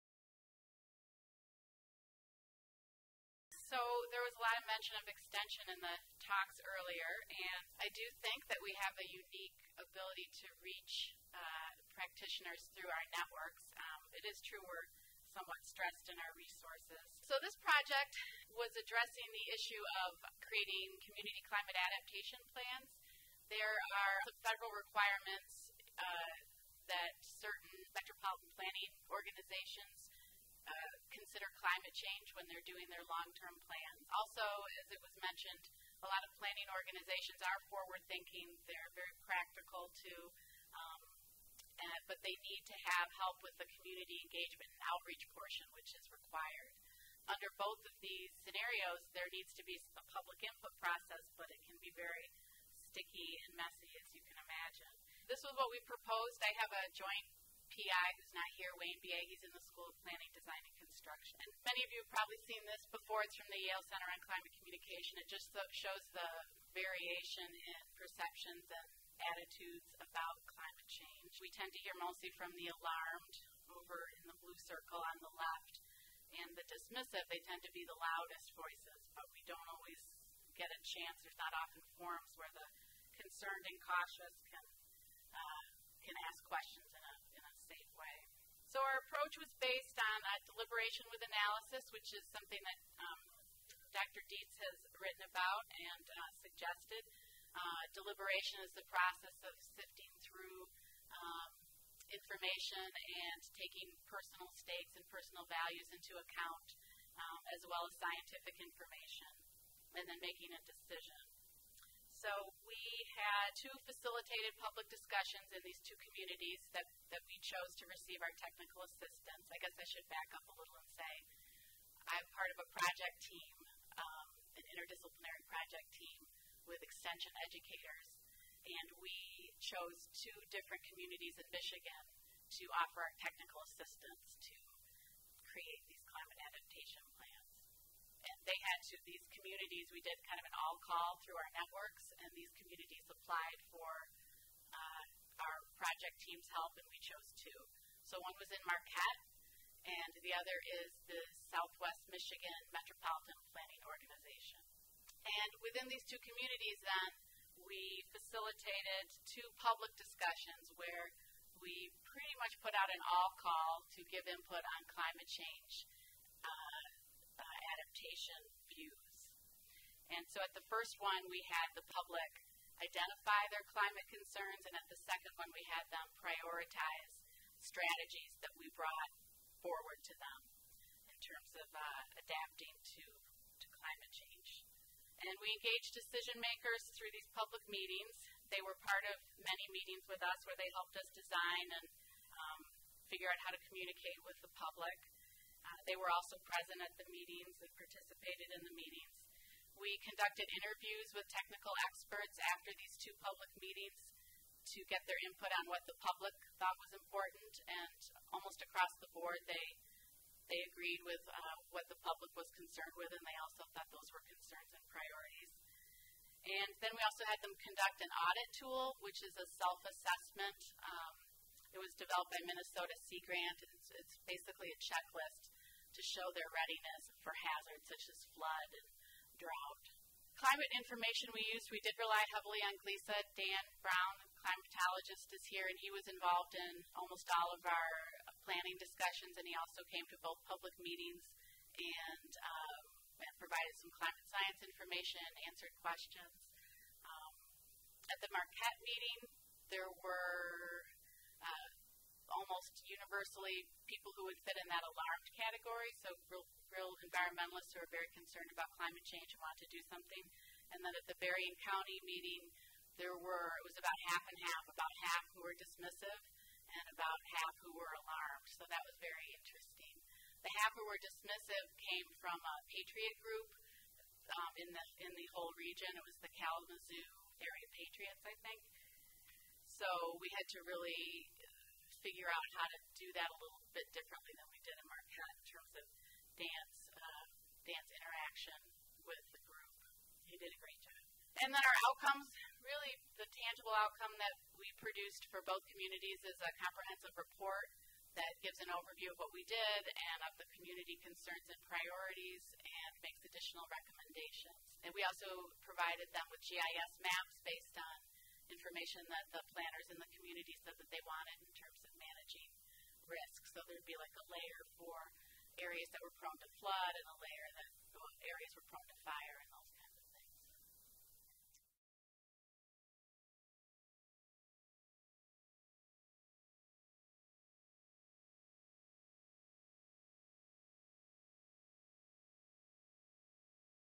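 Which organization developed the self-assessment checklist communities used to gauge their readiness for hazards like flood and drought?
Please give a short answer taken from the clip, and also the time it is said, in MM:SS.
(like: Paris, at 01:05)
Minnesota Sea Grant, at 03:42.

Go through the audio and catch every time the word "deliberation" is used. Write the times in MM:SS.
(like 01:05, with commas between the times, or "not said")
01:30, 01:37.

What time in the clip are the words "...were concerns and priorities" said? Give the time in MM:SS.
03:34.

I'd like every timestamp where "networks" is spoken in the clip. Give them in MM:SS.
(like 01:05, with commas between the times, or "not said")
00:13, 02:21.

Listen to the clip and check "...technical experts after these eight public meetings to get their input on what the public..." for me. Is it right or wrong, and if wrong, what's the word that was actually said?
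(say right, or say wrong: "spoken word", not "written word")
wrong: "two", not "eight".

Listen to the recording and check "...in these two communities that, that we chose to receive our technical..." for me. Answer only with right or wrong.
right.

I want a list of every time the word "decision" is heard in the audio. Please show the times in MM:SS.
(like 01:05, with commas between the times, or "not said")
01:50, 03:05.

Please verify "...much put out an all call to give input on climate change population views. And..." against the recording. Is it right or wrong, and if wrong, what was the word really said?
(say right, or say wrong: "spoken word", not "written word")
right.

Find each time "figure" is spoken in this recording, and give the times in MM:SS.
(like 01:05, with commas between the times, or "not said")
03:13, 04:42.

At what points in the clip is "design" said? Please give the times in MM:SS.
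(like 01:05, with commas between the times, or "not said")
01:00, 03:11.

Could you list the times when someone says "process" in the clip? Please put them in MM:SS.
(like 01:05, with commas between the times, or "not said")
00:50, 01:38.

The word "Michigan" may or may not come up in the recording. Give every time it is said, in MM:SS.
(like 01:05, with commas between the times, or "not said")
02:11, 02:32.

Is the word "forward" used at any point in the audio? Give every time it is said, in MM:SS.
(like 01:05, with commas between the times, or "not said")
00:37, 02:59.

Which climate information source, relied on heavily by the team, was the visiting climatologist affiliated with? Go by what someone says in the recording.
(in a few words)
GLISA.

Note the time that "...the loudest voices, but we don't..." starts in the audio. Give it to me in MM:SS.
01:17.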